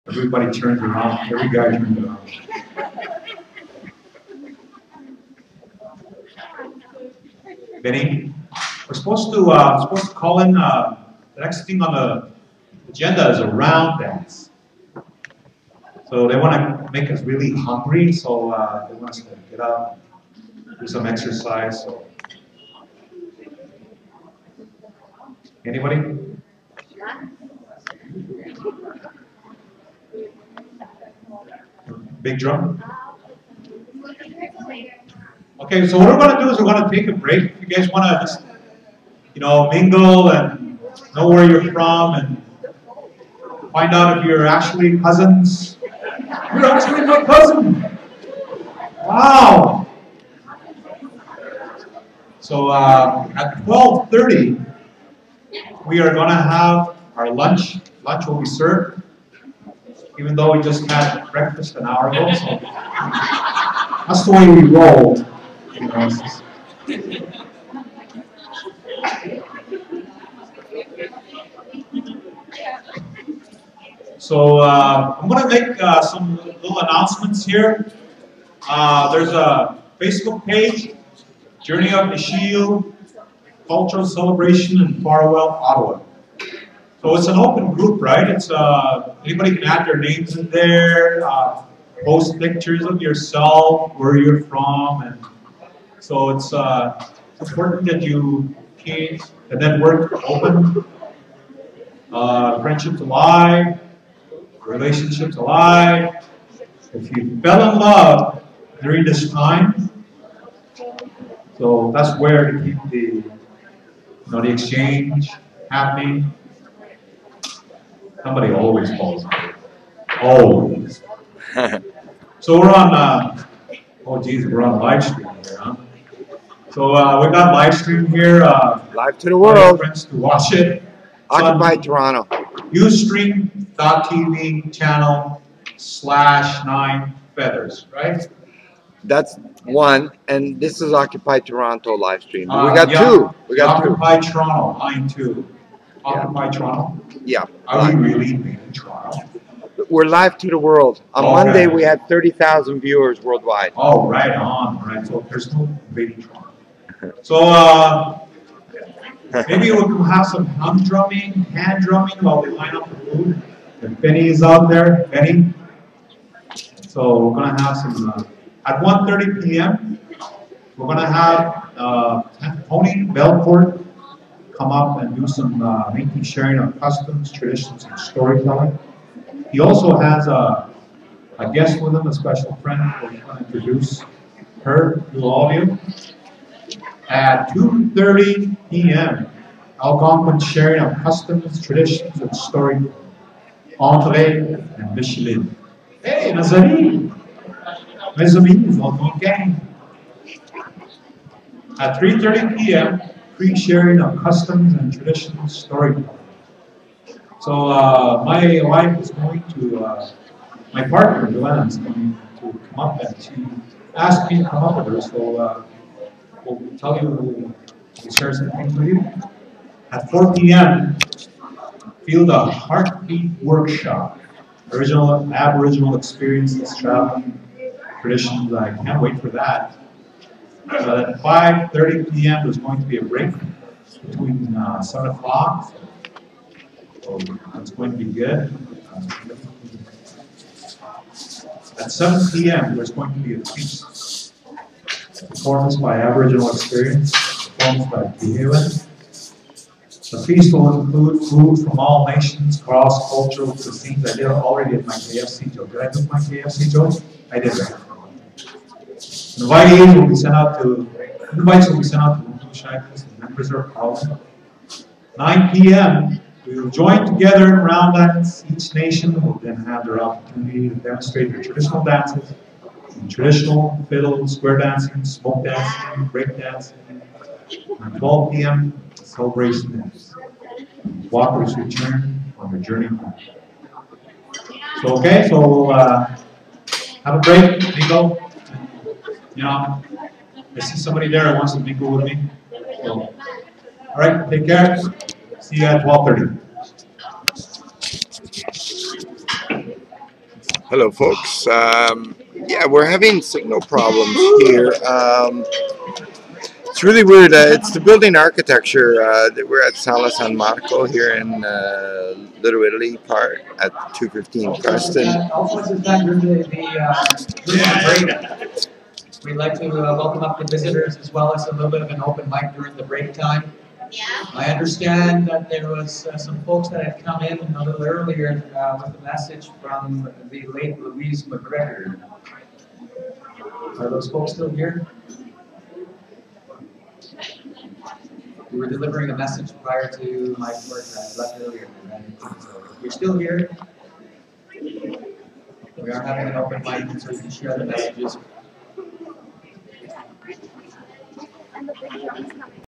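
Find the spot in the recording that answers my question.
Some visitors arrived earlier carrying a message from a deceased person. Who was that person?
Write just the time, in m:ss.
5:30.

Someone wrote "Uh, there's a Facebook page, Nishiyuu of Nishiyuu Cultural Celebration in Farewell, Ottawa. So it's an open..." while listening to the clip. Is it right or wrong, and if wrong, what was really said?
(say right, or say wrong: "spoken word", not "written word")
wrong: "Journey", not "Nishiyuu".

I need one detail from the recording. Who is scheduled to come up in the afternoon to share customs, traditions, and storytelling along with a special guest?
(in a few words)
Tony Belcourt.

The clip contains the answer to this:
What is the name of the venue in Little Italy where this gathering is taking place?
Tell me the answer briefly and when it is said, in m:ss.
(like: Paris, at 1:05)
Sala San Marco, at 5:09.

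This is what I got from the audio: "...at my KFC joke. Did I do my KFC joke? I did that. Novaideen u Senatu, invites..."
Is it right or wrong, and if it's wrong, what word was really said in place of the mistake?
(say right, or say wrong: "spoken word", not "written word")
right.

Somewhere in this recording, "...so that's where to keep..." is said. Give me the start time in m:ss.
1:51.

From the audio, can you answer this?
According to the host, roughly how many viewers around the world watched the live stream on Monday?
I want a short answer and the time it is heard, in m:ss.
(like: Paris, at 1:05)
30,000, at 2:32.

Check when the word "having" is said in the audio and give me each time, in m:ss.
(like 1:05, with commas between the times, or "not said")
5:02, 5:46.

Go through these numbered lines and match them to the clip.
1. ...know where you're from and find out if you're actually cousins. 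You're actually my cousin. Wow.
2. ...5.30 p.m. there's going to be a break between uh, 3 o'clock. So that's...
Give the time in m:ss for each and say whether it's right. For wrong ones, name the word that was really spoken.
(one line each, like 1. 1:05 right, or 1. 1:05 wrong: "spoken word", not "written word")
1. 0:41 right
2. 3:51 wrong: "7", not "3".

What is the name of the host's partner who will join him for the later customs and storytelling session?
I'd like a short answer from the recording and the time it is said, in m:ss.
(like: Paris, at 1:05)
Joanna, at 3:31.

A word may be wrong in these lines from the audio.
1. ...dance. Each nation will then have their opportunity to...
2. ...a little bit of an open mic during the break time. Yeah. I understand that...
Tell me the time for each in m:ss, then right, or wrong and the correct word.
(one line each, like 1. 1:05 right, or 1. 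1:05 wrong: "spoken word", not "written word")
1. 4:27 right
2. 5:21 right.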